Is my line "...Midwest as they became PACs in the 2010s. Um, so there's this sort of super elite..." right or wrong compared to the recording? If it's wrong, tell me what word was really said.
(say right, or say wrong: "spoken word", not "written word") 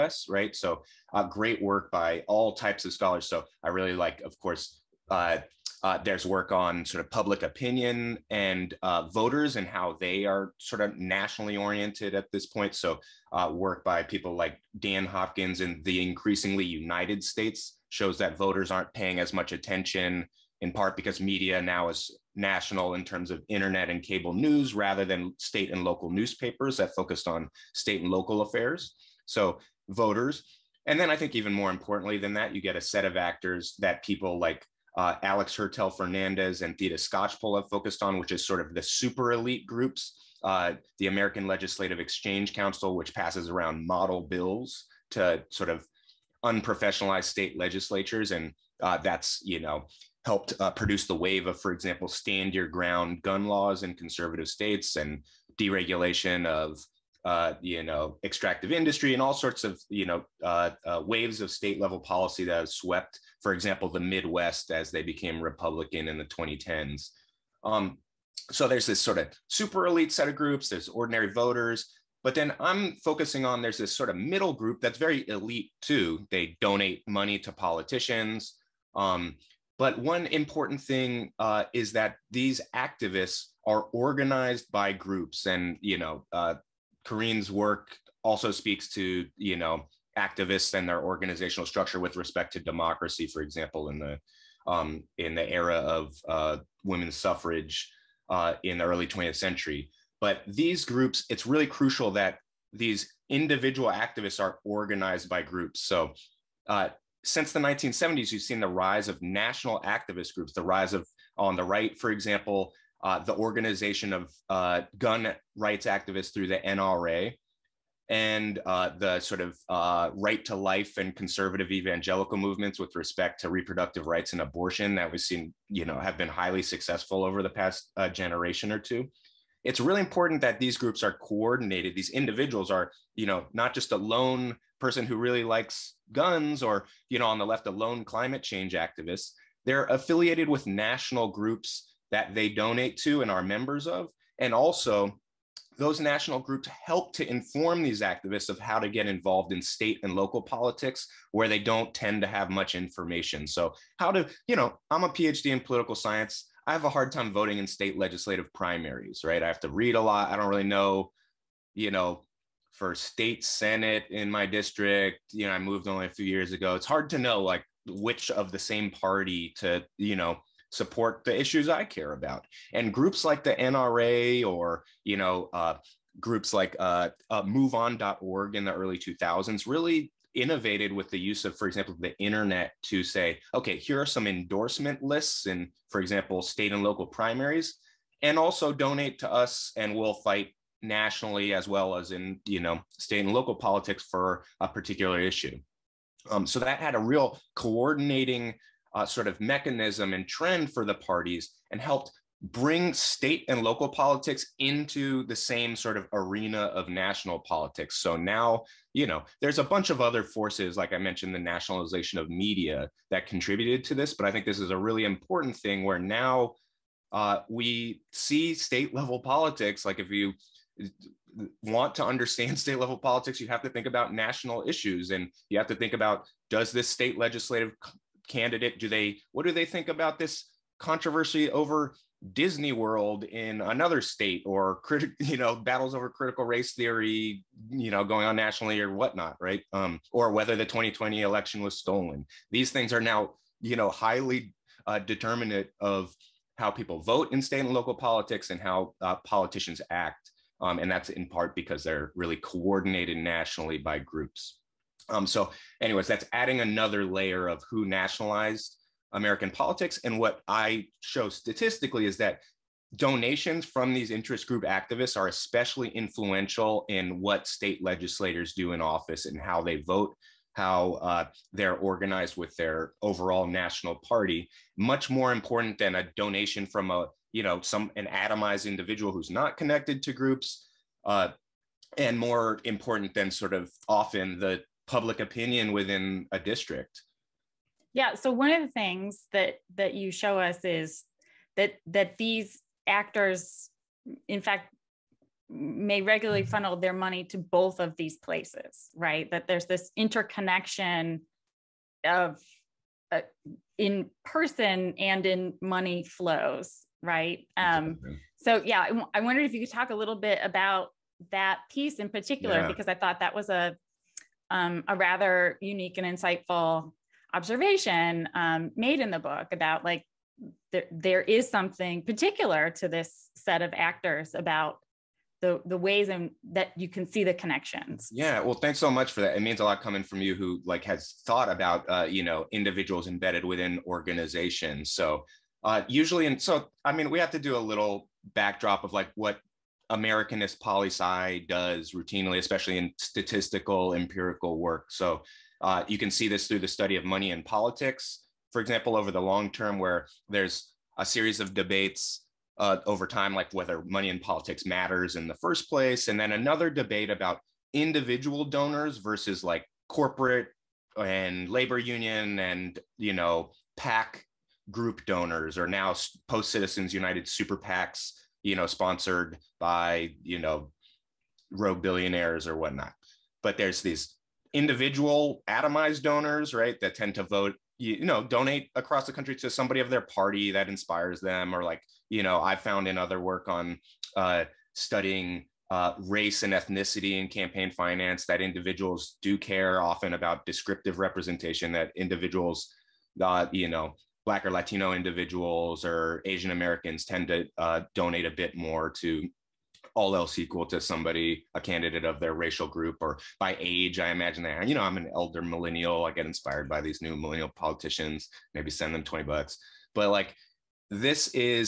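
wrong: "Republican", not "PACs".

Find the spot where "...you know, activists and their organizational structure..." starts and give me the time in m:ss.
1:29.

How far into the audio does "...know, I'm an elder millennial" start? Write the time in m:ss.
6:44.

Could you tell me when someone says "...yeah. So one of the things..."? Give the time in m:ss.
4:47.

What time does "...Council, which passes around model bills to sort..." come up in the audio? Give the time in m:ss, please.
0:42.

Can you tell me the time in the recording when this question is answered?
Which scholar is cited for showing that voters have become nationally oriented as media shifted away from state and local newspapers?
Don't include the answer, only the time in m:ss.
0:14.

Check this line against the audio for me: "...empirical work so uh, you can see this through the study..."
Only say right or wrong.
right.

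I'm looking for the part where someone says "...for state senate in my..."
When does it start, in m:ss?
2:42.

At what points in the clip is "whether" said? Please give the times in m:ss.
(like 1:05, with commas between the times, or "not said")
4:00, 5:53.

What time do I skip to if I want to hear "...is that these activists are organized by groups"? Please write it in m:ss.
1:21.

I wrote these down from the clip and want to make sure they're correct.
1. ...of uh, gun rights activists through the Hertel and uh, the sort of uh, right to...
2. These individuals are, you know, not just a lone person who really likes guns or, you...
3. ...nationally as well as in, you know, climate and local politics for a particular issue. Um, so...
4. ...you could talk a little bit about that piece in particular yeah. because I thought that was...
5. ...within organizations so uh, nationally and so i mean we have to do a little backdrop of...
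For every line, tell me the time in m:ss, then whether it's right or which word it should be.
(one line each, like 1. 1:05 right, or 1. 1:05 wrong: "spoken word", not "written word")
1. 1:54 wrong: "NRA", not "Hertel"
2. 2:11 right
3. 3:10 wrong: "state", not "climate"
4. 5:09 right
5. 5:33 wrong: "usually", not "nationally".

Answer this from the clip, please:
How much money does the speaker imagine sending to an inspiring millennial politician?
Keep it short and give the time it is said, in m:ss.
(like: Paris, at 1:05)
$20, at 6:49.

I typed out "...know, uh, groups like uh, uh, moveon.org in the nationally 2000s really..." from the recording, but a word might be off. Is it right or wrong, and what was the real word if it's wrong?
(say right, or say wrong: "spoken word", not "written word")
wrong: "early", not "nationally".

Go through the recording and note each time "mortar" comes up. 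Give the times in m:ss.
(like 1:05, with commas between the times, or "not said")
not said.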